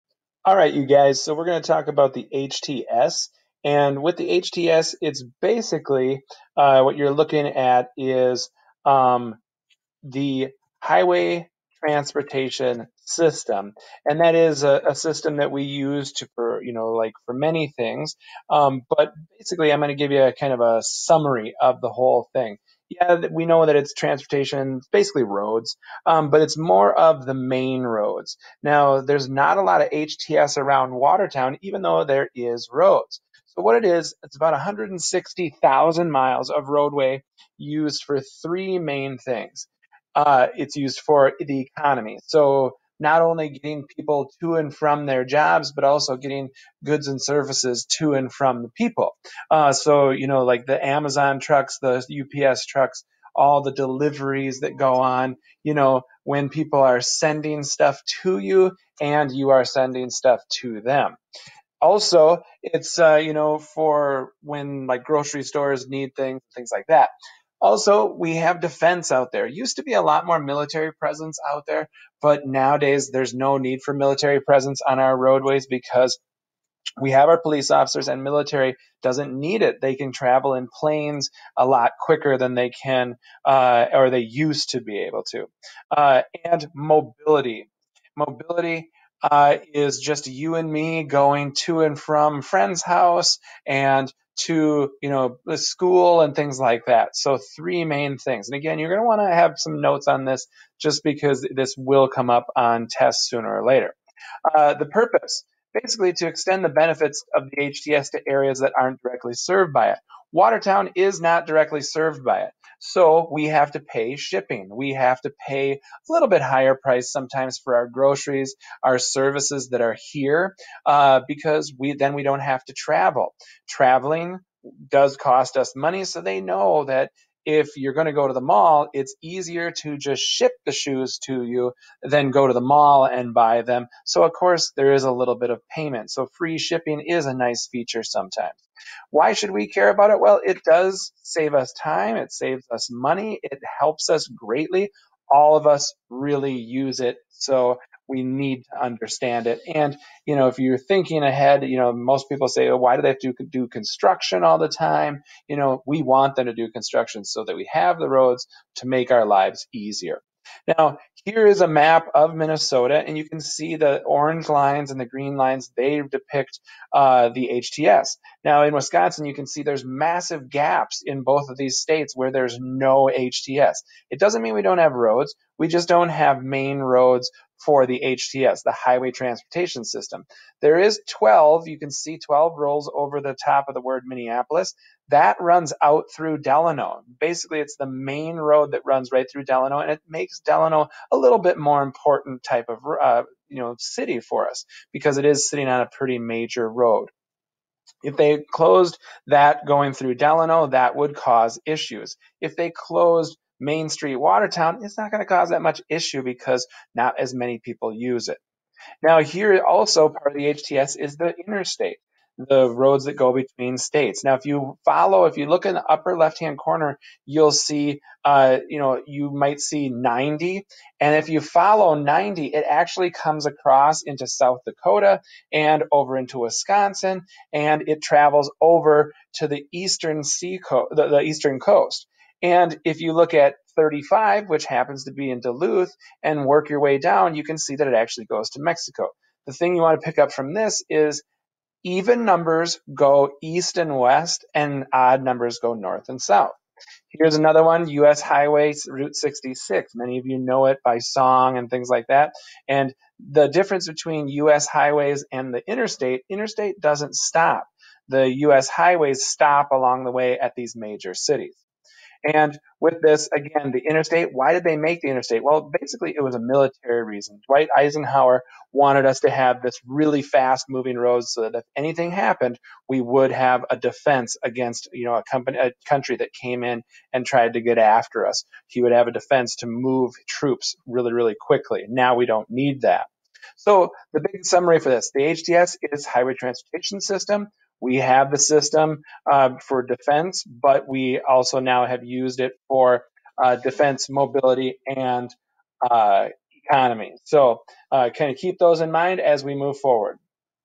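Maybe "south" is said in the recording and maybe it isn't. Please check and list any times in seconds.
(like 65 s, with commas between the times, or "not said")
224 s, 246 s.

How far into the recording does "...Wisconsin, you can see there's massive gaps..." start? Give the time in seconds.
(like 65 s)
168 s.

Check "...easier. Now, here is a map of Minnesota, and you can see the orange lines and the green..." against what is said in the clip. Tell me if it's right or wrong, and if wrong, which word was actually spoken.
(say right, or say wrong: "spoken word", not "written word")
right.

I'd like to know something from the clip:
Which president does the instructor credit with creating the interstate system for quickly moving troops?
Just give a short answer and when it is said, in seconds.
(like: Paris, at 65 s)
Dwight Eisenhower, at 267 s.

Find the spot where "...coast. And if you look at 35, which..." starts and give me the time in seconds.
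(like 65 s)
231 s.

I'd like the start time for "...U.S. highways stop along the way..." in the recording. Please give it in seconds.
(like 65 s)
258 s.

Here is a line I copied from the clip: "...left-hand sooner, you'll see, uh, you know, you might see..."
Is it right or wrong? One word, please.
wrong.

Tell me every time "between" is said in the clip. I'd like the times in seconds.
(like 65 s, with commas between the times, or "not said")
213 s, 253 s.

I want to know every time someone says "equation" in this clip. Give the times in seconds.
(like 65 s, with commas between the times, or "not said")
not said.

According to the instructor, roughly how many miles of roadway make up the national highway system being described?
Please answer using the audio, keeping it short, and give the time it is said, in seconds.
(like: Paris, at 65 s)
160,000 miles, at 34 s.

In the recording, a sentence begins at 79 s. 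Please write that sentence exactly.
They can travel in planes a lot quicker than they can uh, or they used to be able to.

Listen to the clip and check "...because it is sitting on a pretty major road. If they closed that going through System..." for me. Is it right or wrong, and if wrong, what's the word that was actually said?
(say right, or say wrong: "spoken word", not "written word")
wrong: "Delano", not "System".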